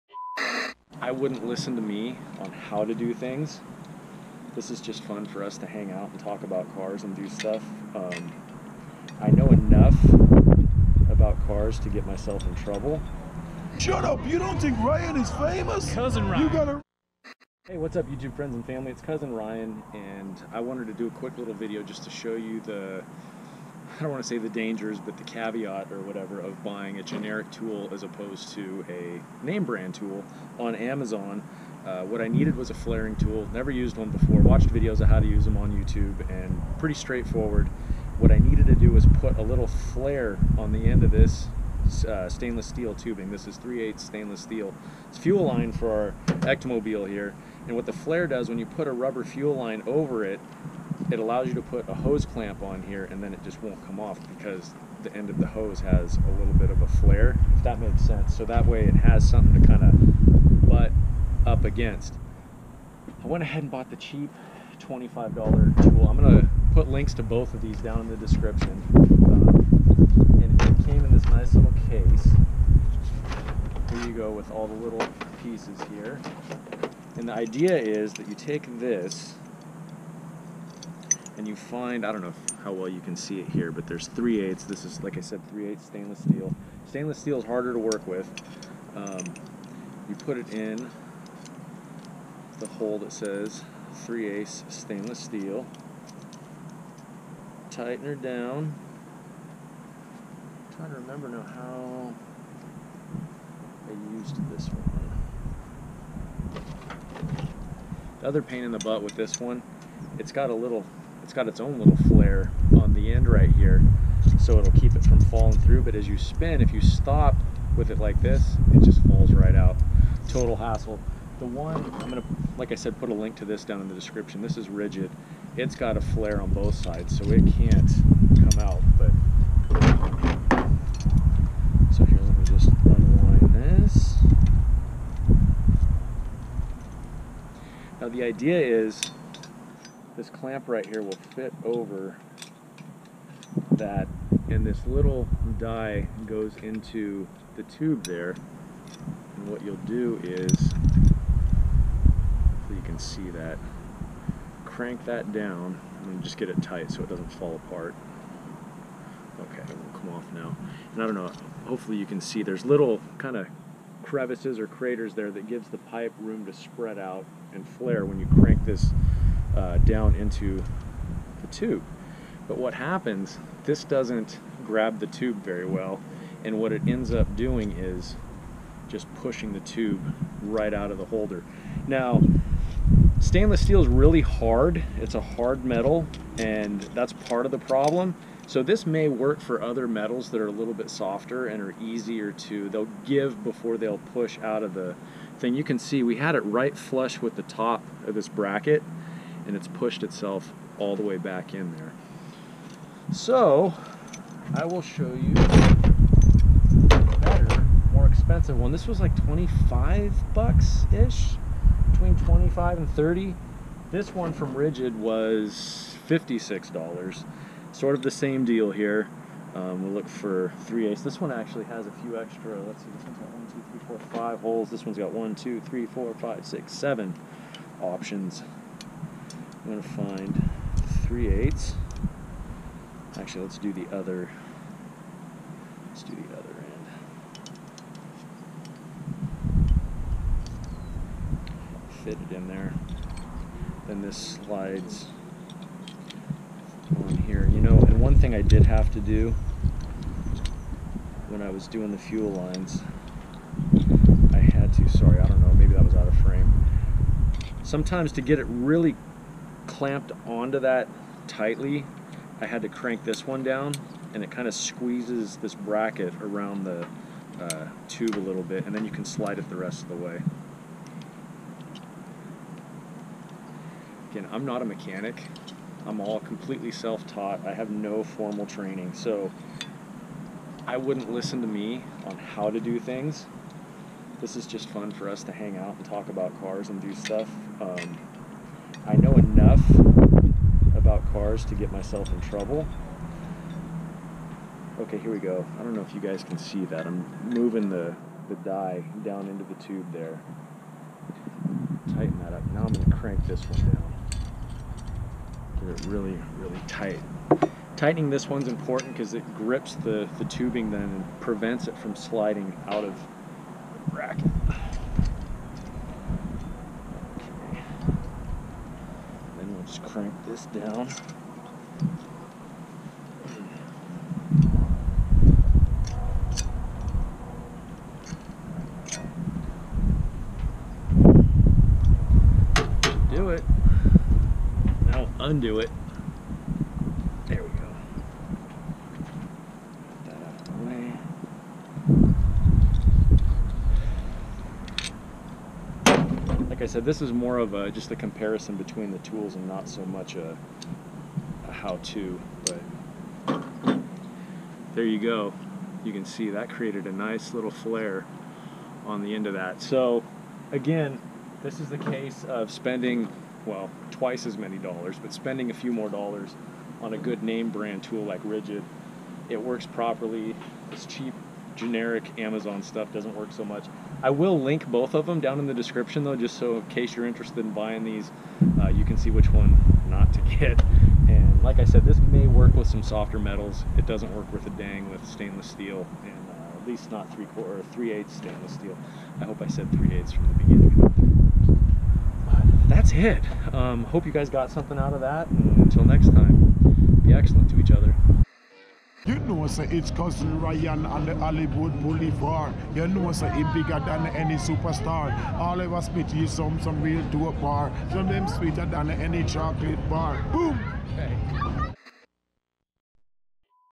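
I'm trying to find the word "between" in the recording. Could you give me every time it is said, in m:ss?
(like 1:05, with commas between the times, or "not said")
3:31, 5:48.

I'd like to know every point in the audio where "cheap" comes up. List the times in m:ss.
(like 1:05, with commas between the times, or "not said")
1:03, 6:10.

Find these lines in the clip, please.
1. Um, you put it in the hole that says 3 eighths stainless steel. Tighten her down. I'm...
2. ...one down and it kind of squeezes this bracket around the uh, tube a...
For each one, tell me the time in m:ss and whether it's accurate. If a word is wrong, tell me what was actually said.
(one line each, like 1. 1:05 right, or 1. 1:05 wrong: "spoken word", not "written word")
1. 1:28 right
2. 4:23 right.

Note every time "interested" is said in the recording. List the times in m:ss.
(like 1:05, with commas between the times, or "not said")
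6:17.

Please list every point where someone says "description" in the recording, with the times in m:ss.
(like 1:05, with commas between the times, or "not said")
1:08, 2:03, 6:15.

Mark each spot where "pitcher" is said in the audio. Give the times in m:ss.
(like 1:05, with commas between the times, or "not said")
not said.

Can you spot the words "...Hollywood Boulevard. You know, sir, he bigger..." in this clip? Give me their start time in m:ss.
6:41.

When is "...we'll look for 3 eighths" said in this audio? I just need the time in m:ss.
3:39.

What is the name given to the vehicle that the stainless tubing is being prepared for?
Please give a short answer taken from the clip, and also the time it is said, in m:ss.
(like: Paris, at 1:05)
Ectomobile, at 0:46.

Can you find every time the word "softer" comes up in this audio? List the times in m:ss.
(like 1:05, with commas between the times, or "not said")
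3:10, 6:22.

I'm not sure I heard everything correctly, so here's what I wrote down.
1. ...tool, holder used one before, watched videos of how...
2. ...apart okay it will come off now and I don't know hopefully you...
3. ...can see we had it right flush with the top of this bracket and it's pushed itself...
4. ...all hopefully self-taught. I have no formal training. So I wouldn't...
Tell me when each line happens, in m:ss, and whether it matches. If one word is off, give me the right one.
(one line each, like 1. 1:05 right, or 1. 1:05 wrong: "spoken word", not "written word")
1. 0:33 wrong: "never", not "holder"
2. 2:37 right
3. 3:15 right
4. 4:36 wrong: "completely", not "hopefully".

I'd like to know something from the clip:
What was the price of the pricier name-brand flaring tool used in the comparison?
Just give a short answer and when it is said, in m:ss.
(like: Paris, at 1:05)
$56, at 3:36.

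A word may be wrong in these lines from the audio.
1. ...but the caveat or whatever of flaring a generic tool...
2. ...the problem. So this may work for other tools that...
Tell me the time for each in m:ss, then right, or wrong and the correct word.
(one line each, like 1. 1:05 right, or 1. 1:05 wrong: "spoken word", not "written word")
1. 0:24 wrong: "buying", not "flaring"
2. 3:07 wrong: "metals", not "tools".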